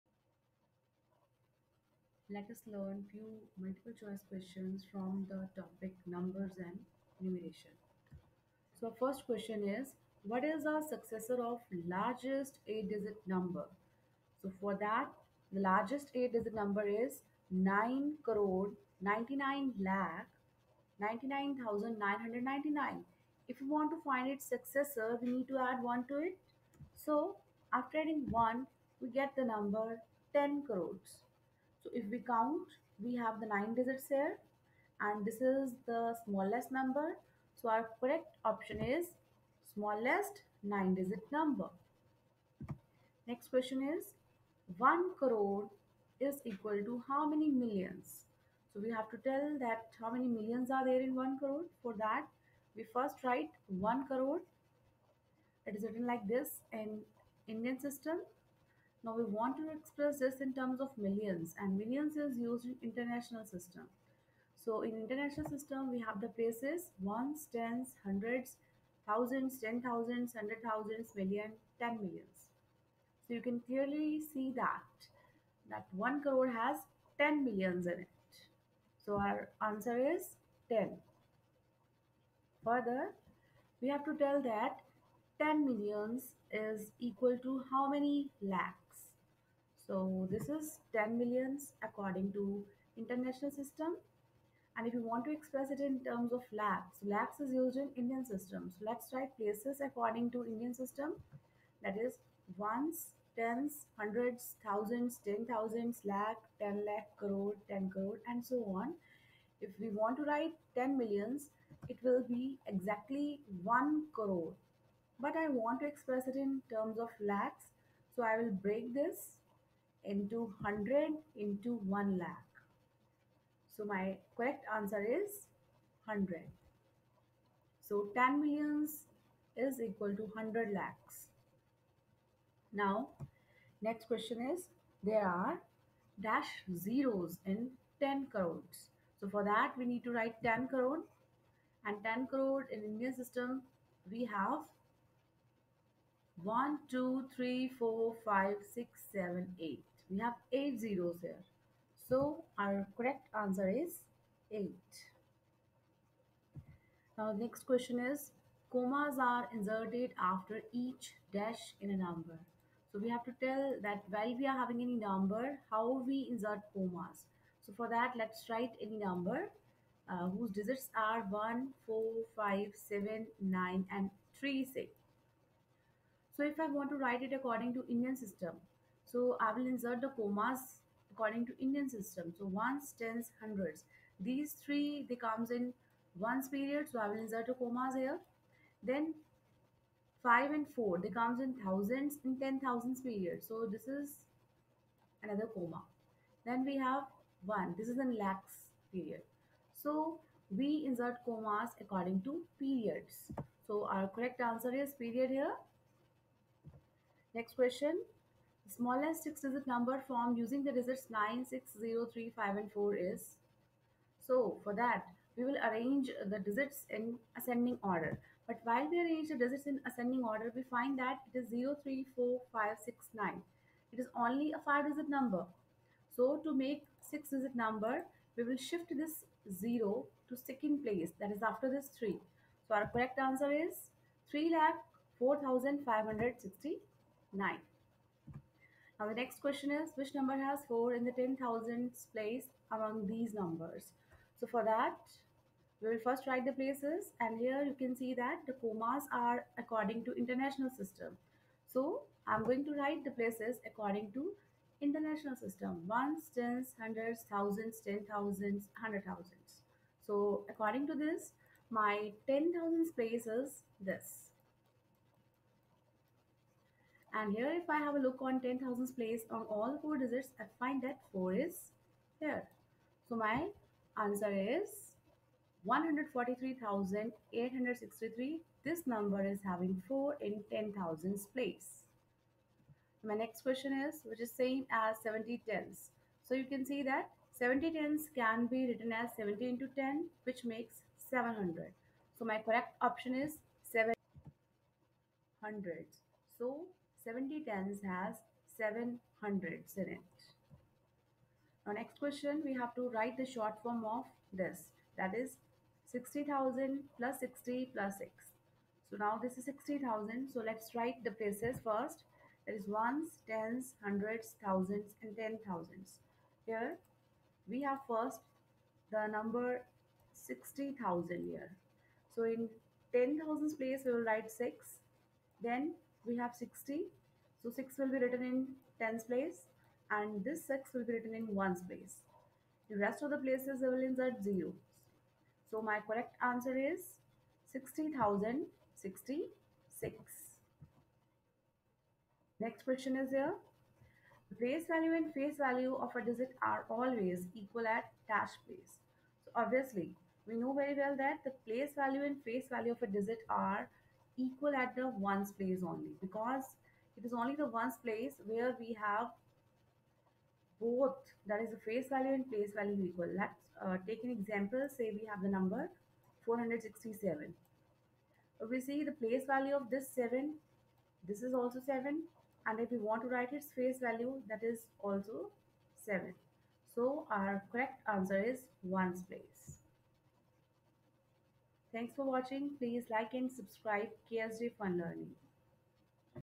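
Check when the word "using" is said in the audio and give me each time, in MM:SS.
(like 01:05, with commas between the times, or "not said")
03:30.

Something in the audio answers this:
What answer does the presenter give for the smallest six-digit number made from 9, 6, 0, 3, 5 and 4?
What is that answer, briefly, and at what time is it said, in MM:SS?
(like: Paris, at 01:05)
3 lakh 4569, at 03:54.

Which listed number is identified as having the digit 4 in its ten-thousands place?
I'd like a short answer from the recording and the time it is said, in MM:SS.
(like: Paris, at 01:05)
143,863, at 04:35.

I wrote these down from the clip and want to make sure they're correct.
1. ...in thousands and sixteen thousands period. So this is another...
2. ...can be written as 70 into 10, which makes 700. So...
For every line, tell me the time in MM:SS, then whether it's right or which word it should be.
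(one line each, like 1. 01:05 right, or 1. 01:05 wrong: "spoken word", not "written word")
1. 03:11 wrong: "ten", not "sixteen"
2. 04:48 right.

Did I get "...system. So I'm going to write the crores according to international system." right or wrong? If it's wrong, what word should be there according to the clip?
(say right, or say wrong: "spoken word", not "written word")
wrong: "places", not "crores".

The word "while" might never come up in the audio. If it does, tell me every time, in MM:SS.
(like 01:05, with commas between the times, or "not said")
02:44, 03:38.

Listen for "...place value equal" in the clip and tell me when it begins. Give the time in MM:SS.
06:02.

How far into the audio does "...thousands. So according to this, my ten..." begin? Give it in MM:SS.
04:19.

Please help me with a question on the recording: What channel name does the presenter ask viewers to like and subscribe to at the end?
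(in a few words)
KSJ Fun Learning.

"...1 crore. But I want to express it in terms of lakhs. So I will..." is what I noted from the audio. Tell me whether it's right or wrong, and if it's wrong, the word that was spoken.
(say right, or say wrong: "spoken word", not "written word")
right.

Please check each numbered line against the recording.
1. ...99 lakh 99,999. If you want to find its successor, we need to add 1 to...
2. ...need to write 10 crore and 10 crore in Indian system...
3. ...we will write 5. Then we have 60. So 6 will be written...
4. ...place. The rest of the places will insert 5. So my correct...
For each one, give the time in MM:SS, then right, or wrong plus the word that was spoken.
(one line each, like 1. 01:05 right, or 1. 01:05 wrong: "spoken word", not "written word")
1. 00:19 right
2. 02:19 right
3. 05:23 wrong: "6", not "5"
4. 05:31 wrong: "0", not "5".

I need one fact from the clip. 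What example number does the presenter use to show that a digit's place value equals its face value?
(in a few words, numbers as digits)
467.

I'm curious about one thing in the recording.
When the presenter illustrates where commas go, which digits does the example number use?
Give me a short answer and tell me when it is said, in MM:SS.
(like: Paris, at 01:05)
1, 4, 5, 7, 9, 3, 6, at 02:51.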